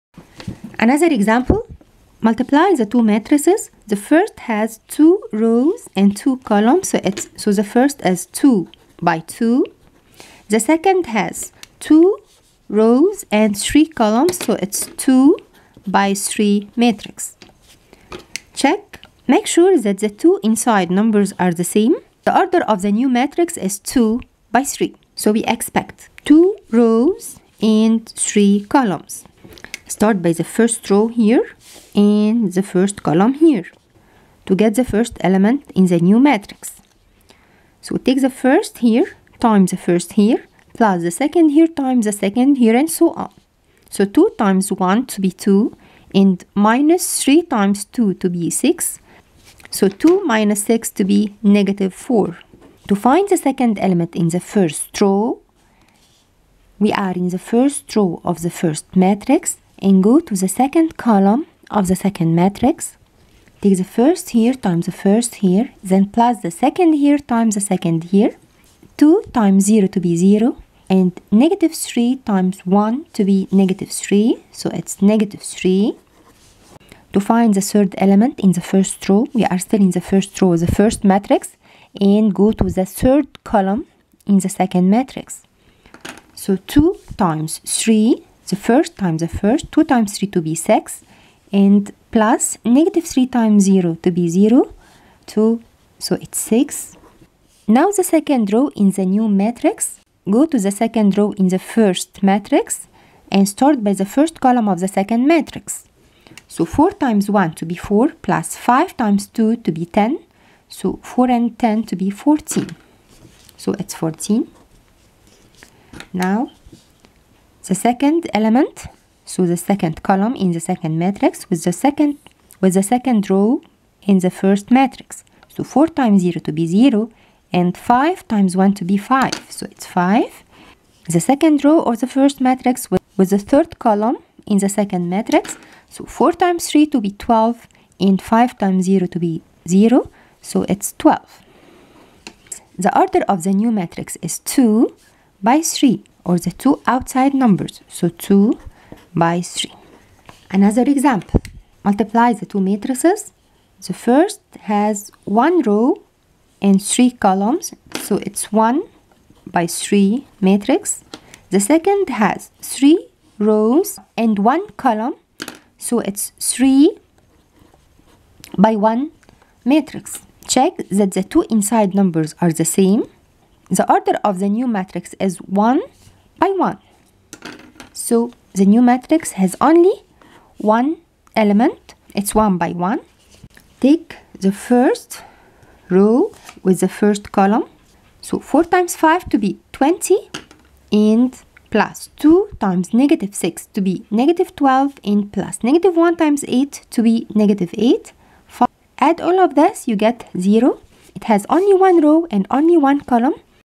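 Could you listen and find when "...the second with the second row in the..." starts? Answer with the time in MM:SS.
02:01.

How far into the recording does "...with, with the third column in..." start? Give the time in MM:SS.
02:12.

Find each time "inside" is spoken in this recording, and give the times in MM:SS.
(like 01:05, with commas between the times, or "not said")
00:20, 02:51.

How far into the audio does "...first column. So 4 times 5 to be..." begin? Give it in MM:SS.
03:06.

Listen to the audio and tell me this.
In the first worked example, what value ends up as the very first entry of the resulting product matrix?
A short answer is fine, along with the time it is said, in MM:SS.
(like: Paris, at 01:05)
-4, at 00:51.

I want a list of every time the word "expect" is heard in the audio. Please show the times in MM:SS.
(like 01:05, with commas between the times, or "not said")
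00:25.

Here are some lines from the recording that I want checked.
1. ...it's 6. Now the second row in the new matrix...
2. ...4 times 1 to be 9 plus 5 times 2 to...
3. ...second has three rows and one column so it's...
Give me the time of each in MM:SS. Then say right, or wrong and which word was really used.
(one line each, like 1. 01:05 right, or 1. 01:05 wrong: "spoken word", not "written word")
1. 01:36 right
2. 01:46 wrong: "4", not "9"
3. 02:41 right.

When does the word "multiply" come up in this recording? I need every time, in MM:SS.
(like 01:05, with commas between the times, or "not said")
00:02, 02:31.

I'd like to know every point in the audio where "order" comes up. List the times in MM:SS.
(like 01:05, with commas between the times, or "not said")
00:22, 02:22, 02:53.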